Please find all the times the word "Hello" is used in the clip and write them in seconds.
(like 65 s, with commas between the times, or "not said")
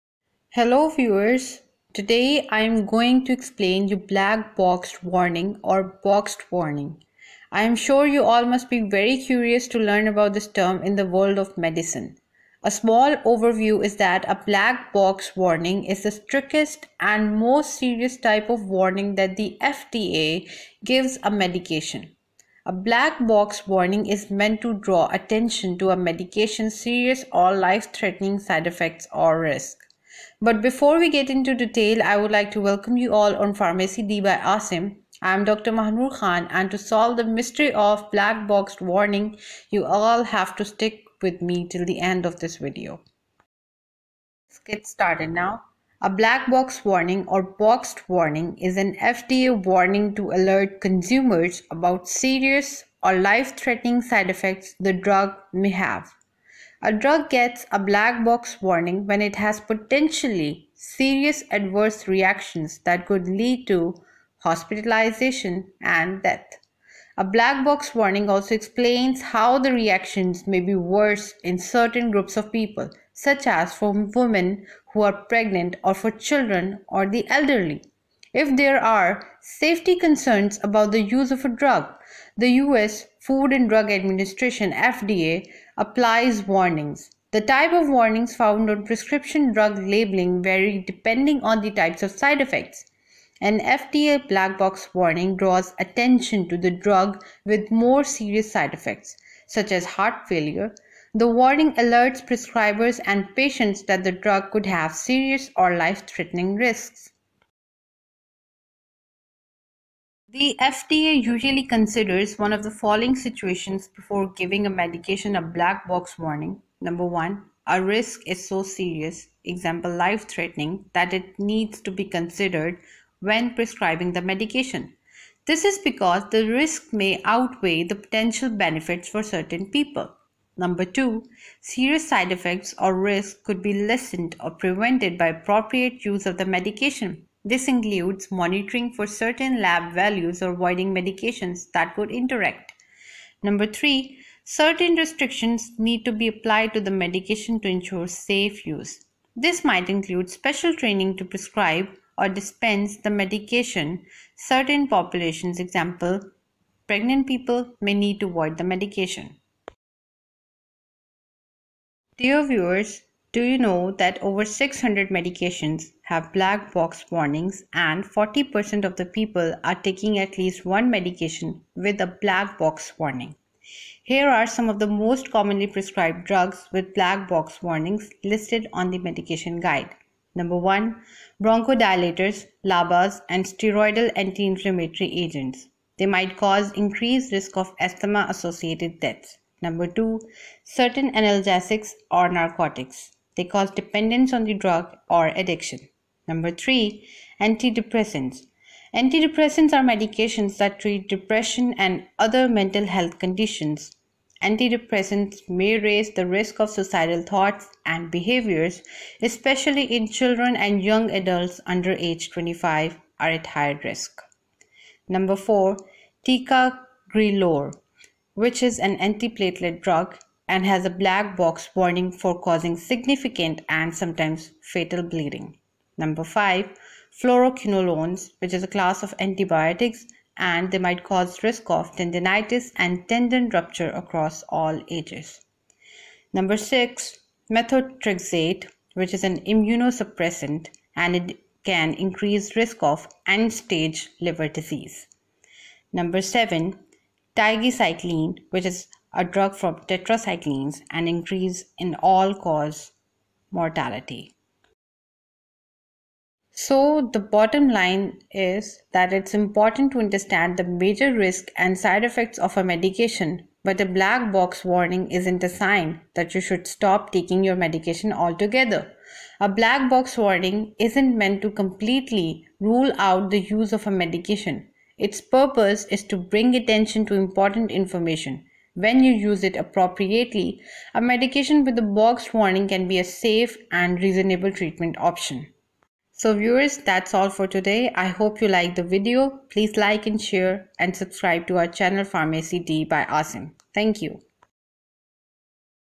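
0 s.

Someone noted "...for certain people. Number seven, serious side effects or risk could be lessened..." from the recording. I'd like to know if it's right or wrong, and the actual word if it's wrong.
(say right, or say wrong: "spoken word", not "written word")
wrong: "two", not "seven".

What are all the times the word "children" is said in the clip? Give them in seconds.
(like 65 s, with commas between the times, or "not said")
76 s, 210 s.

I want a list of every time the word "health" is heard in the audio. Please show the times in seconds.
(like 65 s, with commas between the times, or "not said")
202 s.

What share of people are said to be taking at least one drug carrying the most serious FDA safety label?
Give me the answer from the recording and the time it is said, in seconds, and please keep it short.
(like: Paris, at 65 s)
40%, at 168 s.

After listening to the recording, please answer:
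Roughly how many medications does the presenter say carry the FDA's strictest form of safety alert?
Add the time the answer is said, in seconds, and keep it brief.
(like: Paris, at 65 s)
over 600, at 164 s.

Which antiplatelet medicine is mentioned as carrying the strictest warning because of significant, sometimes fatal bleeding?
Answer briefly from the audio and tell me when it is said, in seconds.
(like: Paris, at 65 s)
Ticagrelor, at 216 s.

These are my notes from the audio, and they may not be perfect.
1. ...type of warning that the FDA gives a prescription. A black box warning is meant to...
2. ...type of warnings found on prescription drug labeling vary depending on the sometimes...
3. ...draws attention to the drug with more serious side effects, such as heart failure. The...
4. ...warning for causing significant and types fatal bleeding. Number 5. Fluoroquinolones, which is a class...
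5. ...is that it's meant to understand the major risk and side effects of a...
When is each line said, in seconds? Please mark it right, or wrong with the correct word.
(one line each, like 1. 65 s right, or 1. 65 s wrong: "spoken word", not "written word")
1. 18 s wrong: "medication", not "prescription"
2. 87 s wrong: "types", not "sometimes"
3. 95 s right
4. 221 s wrong: "sometimes", not "types"
5. 258 s wrong: "important", not "meant".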